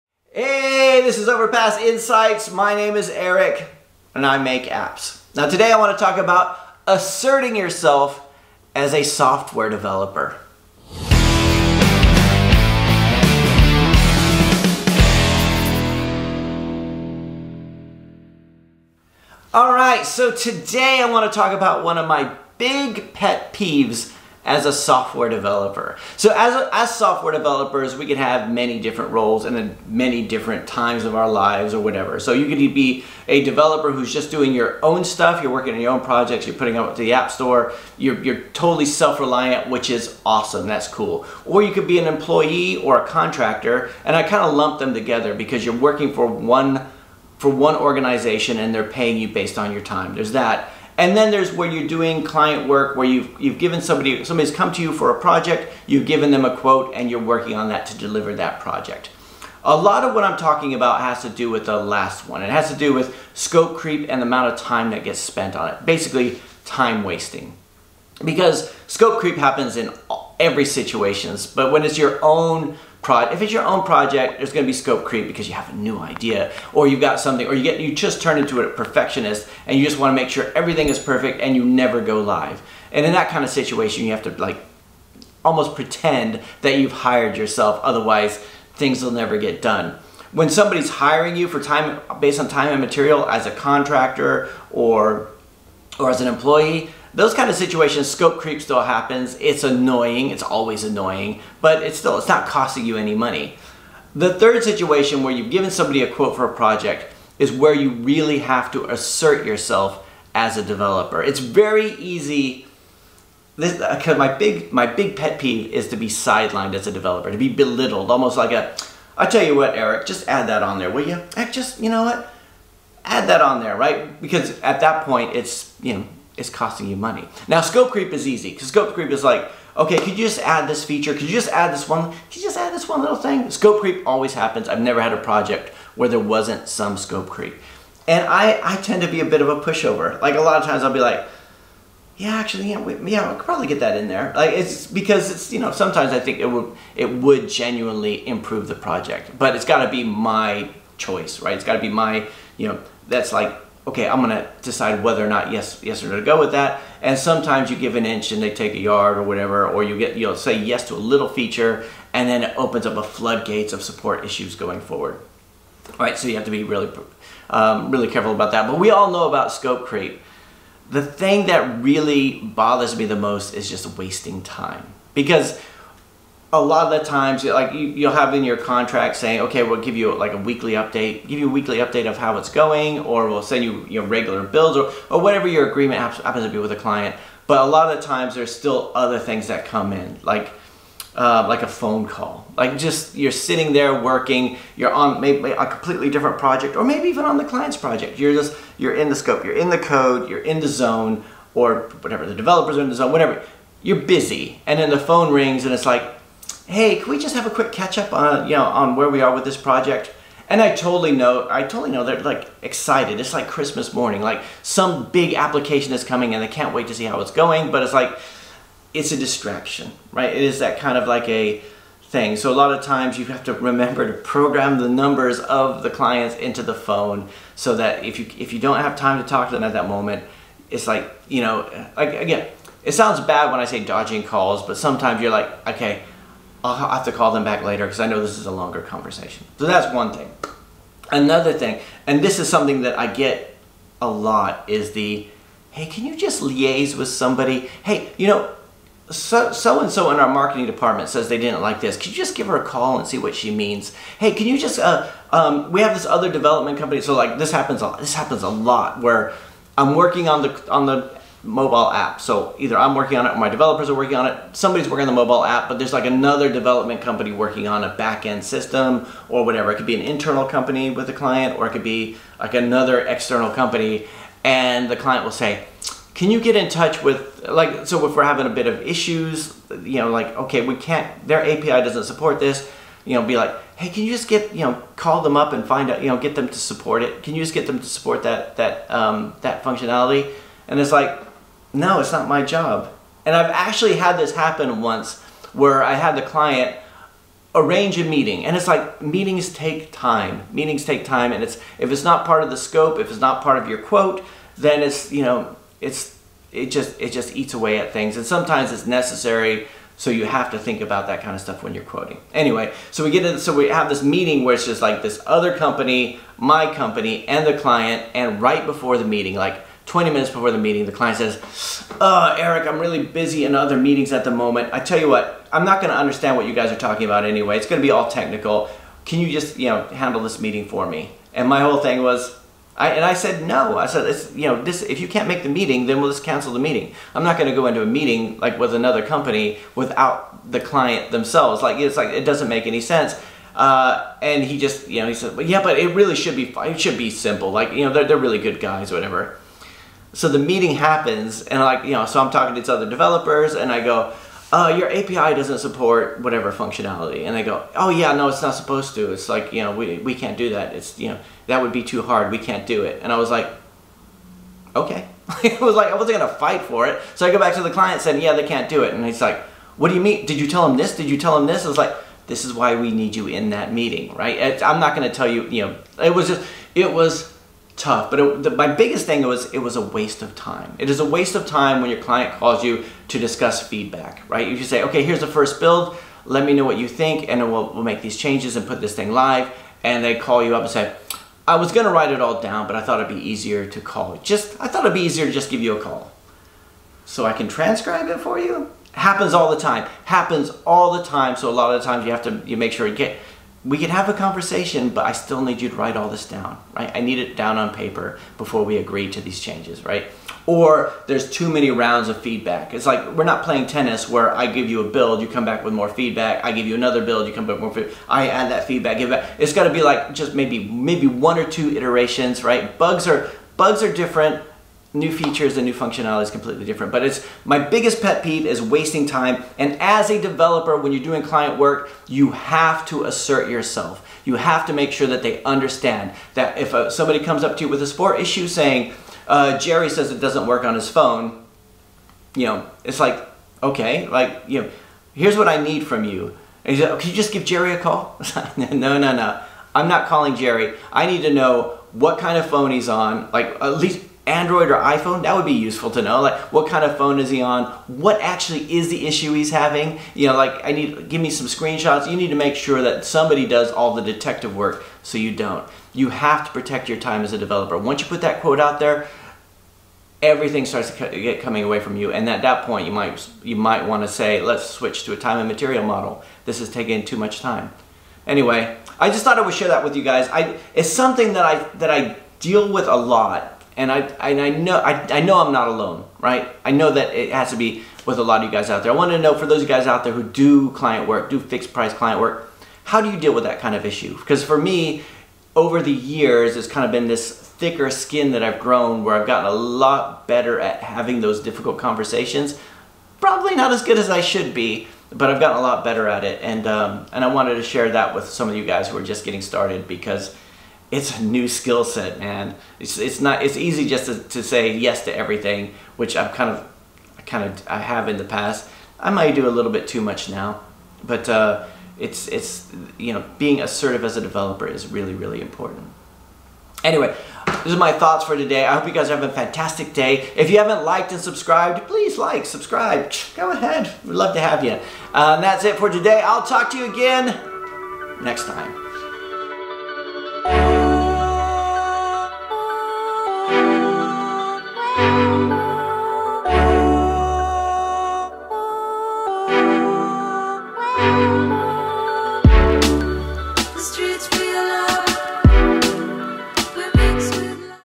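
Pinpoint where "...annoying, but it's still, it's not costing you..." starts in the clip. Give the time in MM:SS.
01:40.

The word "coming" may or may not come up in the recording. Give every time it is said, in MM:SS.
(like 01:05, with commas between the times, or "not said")
03:36, 07:51.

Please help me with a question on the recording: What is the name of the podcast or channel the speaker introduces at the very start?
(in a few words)
Overpass Insights.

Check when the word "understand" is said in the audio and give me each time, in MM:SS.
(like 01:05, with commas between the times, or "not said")
05:25, 07:15.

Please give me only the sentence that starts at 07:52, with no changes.
And at that point, you might, you might want to say, let's switch to a time and material model.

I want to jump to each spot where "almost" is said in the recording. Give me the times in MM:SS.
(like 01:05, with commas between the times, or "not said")
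01:25, 01:58.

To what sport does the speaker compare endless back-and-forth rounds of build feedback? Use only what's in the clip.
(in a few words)
Tennis.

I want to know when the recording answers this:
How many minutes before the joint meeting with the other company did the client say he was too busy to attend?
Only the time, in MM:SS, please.
05:19.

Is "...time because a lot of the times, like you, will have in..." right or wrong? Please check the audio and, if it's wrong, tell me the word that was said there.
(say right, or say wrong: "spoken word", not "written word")
right.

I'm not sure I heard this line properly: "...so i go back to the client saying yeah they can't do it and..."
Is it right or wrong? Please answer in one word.
right.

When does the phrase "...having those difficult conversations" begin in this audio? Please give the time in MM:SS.
08:20.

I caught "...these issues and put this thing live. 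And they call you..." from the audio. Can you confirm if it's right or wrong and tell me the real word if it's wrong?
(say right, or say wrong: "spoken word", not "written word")
wrong: "changes", not "issues".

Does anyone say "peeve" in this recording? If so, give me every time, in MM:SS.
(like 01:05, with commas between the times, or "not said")
00:23, 01:55, 07:08.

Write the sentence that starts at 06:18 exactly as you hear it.
But it, the, my biggest thing was it was a waste of time.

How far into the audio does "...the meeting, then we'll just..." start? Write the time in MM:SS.
05:35.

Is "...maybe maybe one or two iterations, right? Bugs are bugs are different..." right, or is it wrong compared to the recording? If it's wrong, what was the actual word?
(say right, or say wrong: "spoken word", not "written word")
right.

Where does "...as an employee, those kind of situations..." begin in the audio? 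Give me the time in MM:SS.
01:36.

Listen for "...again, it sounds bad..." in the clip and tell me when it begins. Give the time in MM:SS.
03:52.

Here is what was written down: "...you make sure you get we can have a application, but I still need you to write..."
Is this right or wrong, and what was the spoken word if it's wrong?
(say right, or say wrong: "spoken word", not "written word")
wrong: "conversation", not "application".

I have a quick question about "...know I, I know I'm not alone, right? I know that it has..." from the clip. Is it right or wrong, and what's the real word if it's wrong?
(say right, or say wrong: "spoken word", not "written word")
right.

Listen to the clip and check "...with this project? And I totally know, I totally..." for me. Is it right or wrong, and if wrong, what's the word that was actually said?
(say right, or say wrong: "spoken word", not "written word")
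right.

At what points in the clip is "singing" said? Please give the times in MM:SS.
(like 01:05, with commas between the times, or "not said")
not said.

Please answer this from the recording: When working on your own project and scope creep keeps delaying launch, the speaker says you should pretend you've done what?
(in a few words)
Hired yourself.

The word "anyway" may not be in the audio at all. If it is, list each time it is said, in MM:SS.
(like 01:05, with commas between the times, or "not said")
05:12, 05:27, 07:58, 08:46.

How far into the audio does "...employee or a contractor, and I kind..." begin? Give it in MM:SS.
00:42.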